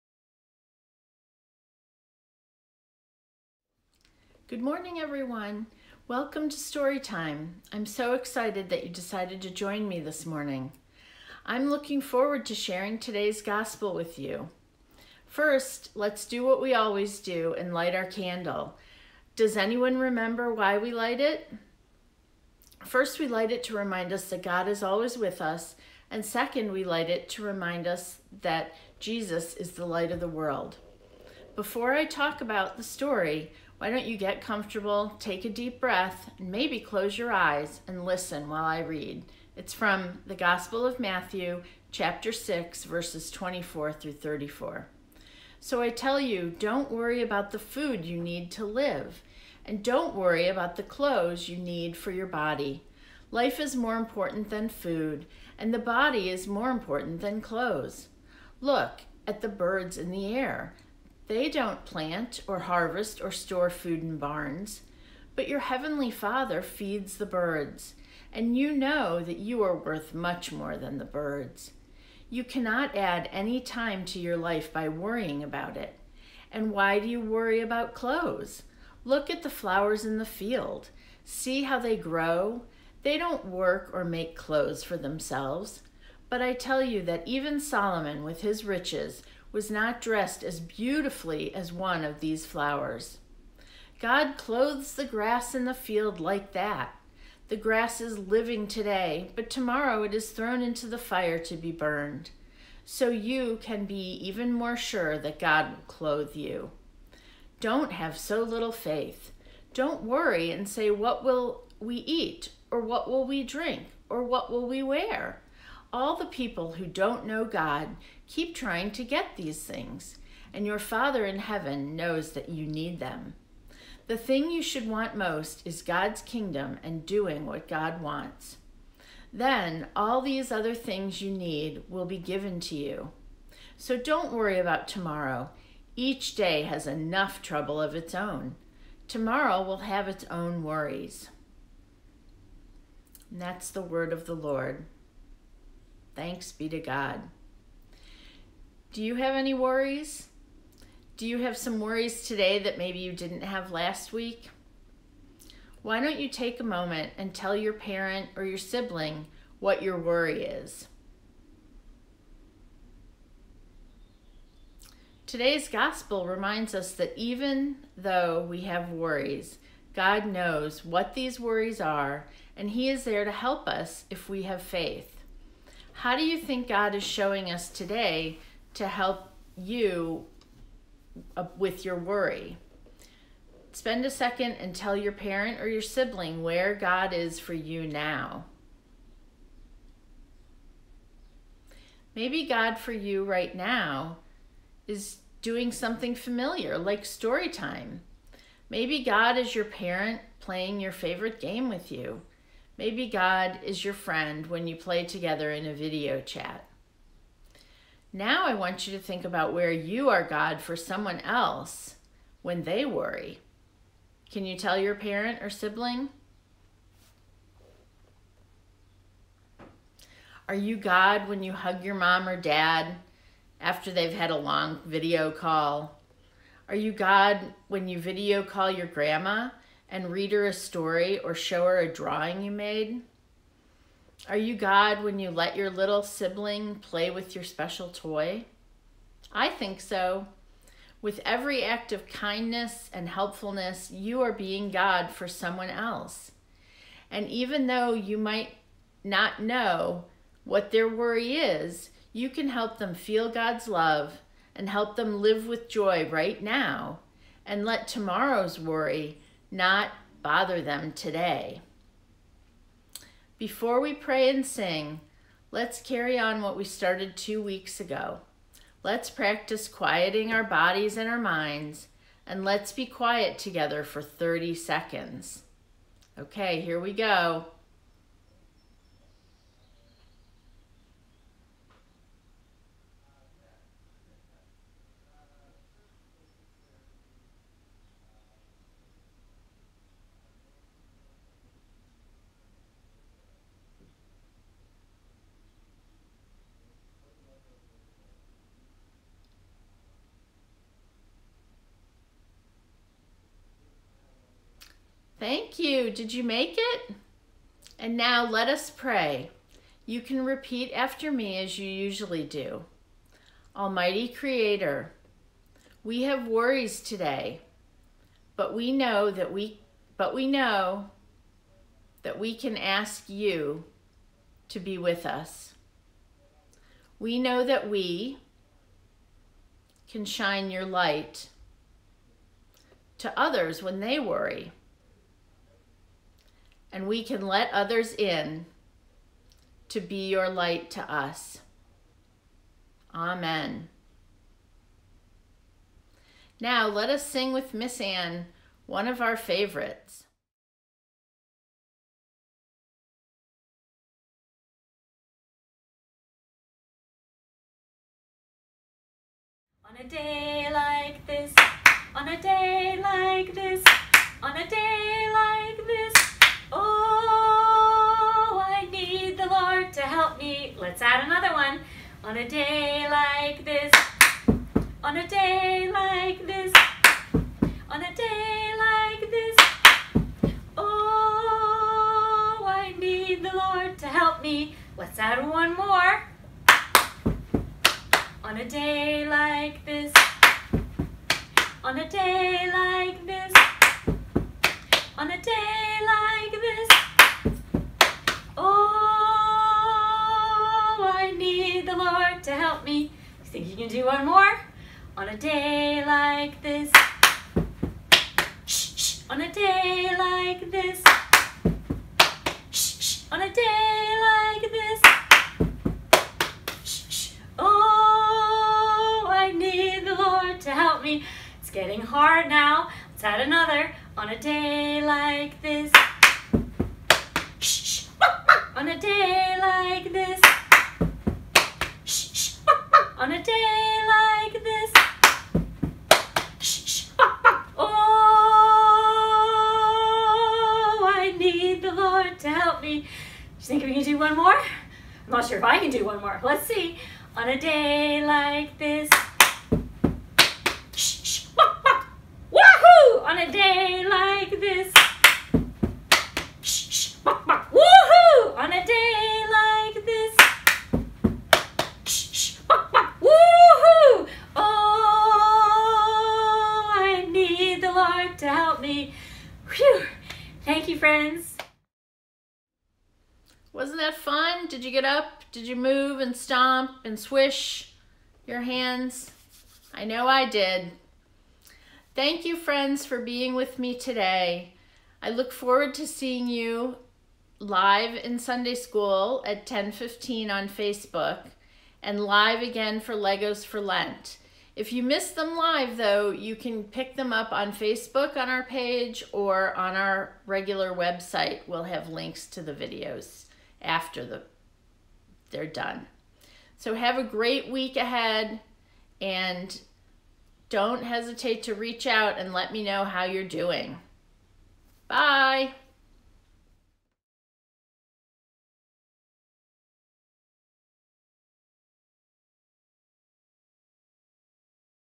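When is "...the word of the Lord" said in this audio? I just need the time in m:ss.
2:23.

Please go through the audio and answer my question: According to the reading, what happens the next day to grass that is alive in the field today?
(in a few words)
thrown into the fire.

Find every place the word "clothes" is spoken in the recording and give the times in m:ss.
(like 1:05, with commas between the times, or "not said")
0:50, 0:57, 1:17, 1:24, 1:34, 1:45.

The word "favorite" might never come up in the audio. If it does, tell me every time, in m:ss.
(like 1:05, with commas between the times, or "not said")
3:20, 5:49.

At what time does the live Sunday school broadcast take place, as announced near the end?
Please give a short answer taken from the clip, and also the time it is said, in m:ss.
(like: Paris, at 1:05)
10:15, at 8:09.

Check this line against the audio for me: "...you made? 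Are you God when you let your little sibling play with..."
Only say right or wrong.
right.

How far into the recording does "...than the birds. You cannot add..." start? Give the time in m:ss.
1:10.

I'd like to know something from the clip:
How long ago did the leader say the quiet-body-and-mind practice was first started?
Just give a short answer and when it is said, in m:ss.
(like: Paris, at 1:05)
two weeks ago, at 4:27.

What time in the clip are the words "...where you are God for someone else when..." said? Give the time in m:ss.
3:29.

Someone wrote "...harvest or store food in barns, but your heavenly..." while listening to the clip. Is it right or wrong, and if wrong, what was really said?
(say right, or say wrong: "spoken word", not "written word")
right.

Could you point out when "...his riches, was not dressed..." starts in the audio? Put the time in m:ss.
1:28.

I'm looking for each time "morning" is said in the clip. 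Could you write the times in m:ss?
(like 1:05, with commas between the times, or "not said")
0:04, 0:10.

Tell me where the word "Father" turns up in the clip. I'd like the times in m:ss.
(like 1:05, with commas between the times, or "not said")
1:06, 2:00.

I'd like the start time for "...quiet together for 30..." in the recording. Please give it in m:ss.
4:32.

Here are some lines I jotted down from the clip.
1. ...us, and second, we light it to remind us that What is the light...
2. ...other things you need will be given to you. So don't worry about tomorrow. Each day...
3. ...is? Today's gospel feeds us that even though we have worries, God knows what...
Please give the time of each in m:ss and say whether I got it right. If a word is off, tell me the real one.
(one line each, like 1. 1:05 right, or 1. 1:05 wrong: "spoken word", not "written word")
1. 0:25 wrong: "Jesus", not "What"
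2. 2:10 right
3. 2:40 wrong: "reminds", not "feeds".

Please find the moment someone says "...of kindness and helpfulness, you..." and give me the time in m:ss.
4:01.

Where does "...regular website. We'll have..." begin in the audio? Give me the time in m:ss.
8:20.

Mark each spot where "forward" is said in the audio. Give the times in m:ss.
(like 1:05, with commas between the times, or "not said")
0:12, 8:05.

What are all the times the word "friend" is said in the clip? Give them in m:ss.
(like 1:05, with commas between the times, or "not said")
3:23, 8:02.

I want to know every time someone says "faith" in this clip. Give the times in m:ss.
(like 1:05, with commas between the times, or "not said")
1:48, 2:54.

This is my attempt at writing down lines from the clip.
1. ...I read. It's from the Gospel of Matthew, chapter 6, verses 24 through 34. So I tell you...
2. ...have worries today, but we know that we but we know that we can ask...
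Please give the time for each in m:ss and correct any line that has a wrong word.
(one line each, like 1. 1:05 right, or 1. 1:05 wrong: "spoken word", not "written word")
1. 0:38 right
2. 5:16 right.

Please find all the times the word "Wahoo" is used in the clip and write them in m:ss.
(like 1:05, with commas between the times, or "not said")
7:32.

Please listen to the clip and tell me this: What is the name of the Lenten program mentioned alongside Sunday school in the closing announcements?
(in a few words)
Legos for Lent.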